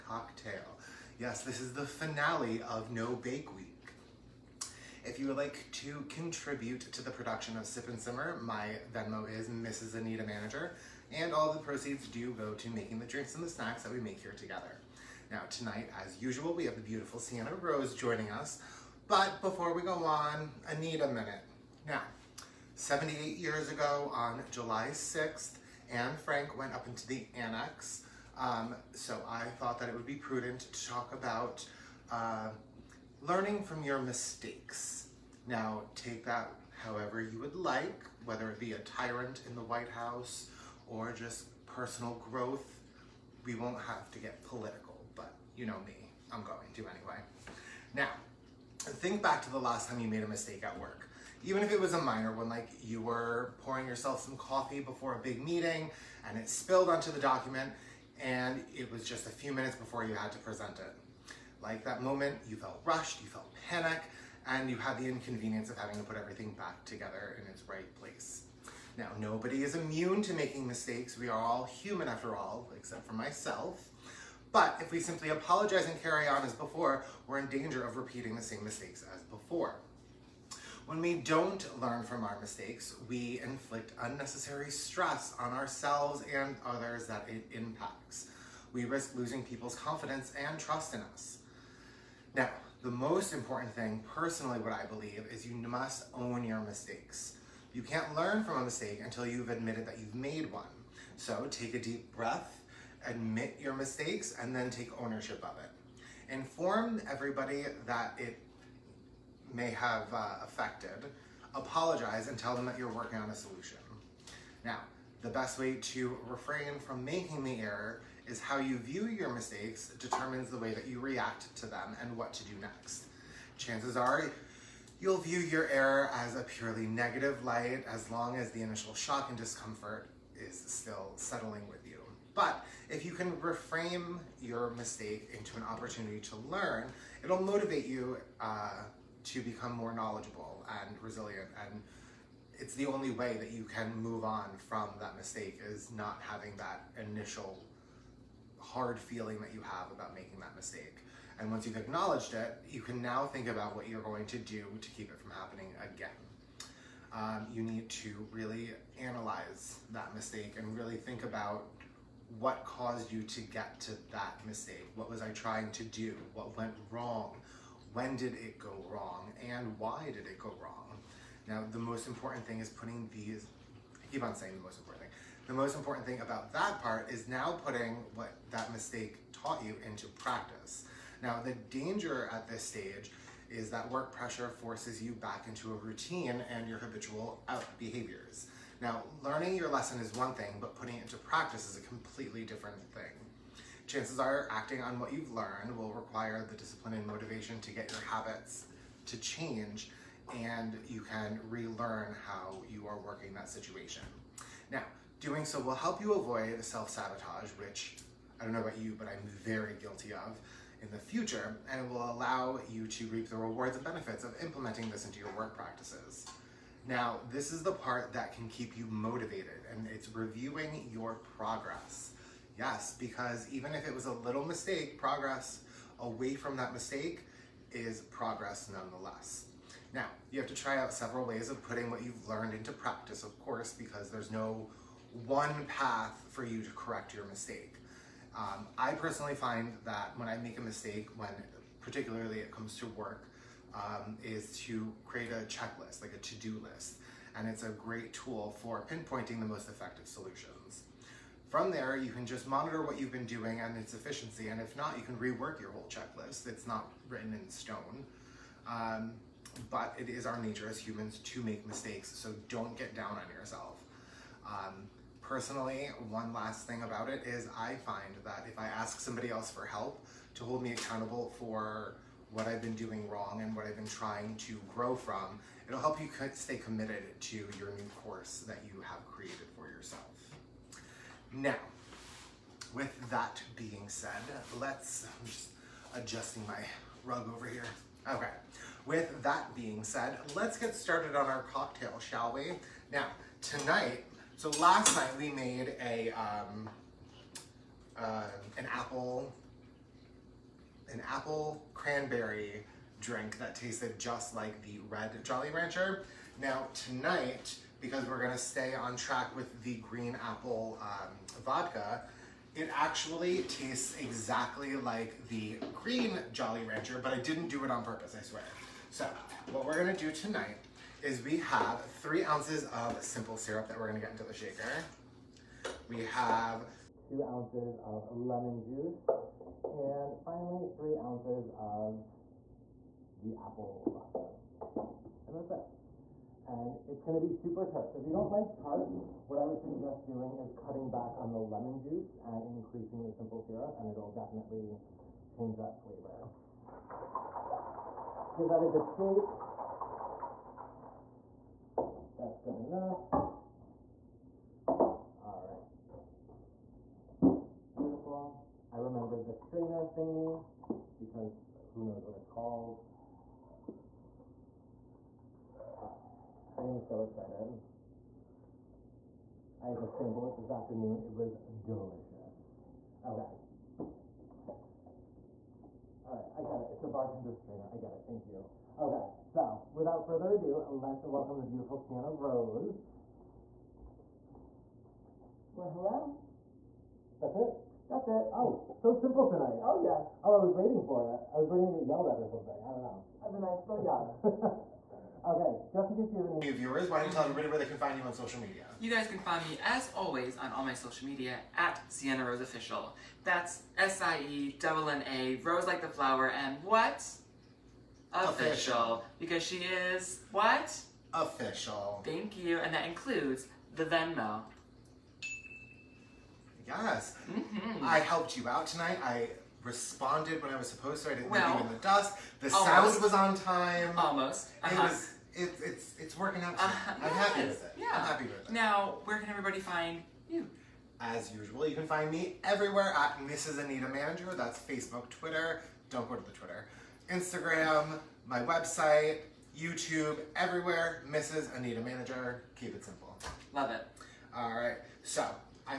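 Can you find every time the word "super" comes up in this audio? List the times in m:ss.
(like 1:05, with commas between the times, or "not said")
5:37.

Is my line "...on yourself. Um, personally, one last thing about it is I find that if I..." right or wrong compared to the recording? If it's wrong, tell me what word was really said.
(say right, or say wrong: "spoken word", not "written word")
right.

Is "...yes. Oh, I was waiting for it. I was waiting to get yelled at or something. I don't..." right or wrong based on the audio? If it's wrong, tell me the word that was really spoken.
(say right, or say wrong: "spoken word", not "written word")
right.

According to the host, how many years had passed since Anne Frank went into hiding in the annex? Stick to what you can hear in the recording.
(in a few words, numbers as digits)
78.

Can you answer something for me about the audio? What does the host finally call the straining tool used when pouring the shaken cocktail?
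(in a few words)
bartender strainer.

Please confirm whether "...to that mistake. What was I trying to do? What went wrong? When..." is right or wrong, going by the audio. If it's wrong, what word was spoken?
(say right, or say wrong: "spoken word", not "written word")
right.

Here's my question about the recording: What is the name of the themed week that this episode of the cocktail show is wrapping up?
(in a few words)
No Bake Week.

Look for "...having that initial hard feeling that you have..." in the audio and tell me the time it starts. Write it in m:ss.
2:26.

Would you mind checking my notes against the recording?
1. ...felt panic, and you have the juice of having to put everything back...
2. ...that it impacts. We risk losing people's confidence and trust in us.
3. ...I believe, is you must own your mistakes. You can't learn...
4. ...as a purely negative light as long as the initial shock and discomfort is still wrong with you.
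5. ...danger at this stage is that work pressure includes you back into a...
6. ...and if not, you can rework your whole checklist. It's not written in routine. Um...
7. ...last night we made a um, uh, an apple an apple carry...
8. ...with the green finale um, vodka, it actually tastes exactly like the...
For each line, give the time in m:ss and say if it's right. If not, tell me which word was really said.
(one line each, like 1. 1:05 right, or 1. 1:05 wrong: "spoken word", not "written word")
1. 1:03 wrong: "inconvenience", not "juice"
2. 1:27 right
3. 1:34 right
4. 2:06 wrong: "settling", not "wrong"
5. 3:01 wrong: "forces", not "includes"
6. 4:14 wrong: "stone", not "routine"
7. 4:54 wrong: "cranberry", not "carry"
8. 5:09 wrong: "apple", not "finale".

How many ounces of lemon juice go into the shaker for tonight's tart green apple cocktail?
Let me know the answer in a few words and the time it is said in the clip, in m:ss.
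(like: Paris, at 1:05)
2, at 5:26.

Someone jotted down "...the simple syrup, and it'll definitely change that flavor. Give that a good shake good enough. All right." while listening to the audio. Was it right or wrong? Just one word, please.
right.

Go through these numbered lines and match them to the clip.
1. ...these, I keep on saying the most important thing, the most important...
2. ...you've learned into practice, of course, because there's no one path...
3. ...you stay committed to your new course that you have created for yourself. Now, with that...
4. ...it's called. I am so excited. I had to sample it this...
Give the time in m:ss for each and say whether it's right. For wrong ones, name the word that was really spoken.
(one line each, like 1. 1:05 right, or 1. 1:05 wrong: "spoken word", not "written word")
1. 2:53 right
2. 3:52 right
3. 4:36 right
4. 6:02 right.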